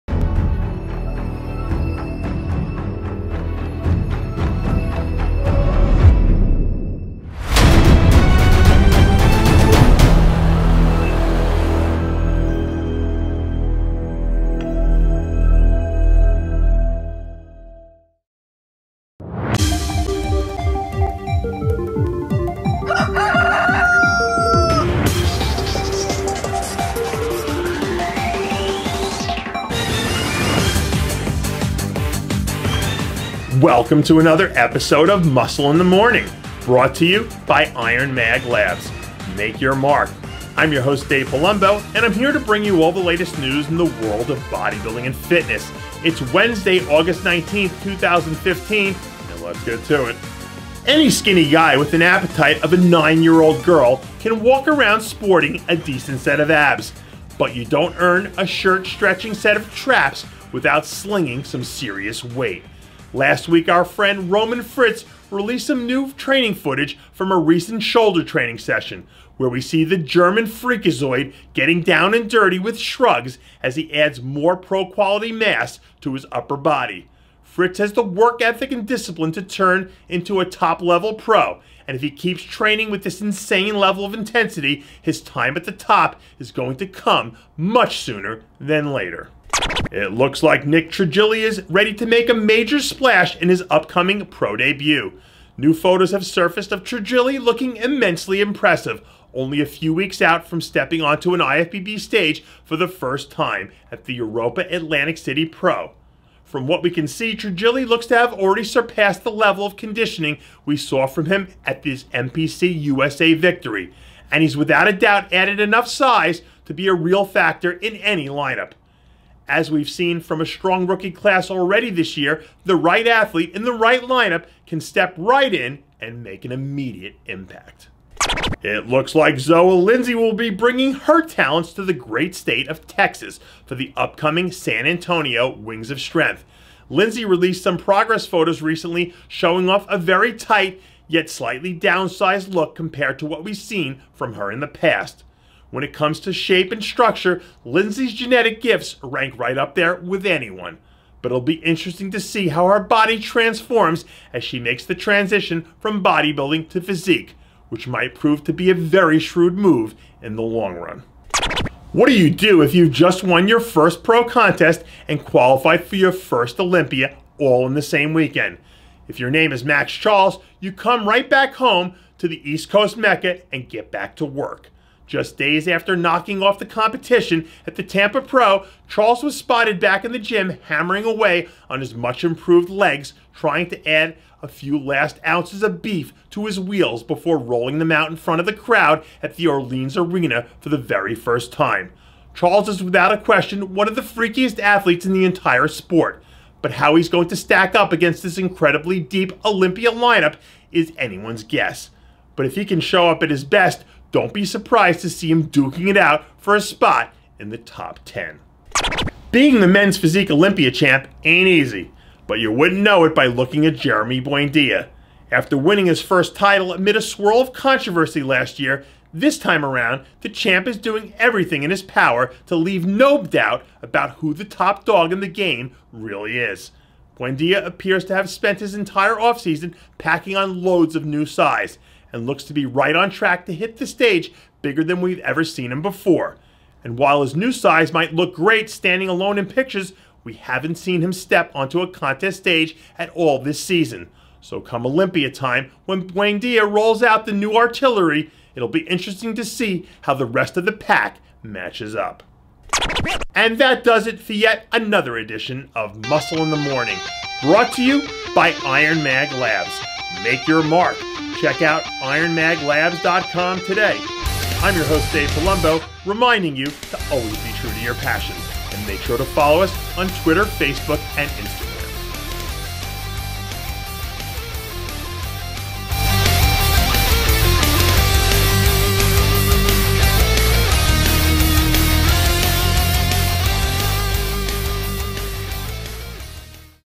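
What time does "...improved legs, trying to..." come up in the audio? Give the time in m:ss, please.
3:02.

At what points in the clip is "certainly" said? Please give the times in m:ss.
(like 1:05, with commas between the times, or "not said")
not said.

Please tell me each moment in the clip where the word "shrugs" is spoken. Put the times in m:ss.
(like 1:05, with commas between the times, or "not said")
1:12.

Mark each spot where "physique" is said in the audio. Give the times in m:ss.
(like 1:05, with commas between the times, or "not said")
2:36, 3:29.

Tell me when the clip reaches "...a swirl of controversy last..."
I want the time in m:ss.
3:36.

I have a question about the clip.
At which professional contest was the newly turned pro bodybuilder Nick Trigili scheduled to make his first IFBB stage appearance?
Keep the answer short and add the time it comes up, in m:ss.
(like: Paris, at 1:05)
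Europa Atlantic City Pro, at 1:44.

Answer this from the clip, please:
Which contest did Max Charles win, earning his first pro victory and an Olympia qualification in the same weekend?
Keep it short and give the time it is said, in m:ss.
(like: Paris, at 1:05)
Tampa Pro, at 2:57.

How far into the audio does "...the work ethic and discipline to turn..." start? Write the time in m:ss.
1:17.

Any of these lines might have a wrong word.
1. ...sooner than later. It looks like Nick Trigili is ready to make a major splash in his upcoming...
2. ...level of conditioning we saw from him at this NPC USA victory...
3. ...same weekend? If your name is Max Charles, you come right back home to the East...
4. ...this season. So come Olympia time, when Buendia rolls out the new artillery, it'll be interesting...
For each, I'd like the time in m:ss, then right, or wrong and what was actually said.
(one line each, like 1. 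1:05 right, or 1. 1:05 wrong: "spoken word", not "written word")
1. 1:27 right
2. 1:49 right
3. 2:47 right
4. 4:03 right.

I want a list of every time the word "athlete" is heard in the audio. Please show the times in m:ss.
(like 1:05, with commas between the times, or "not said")
2:03, 3:14.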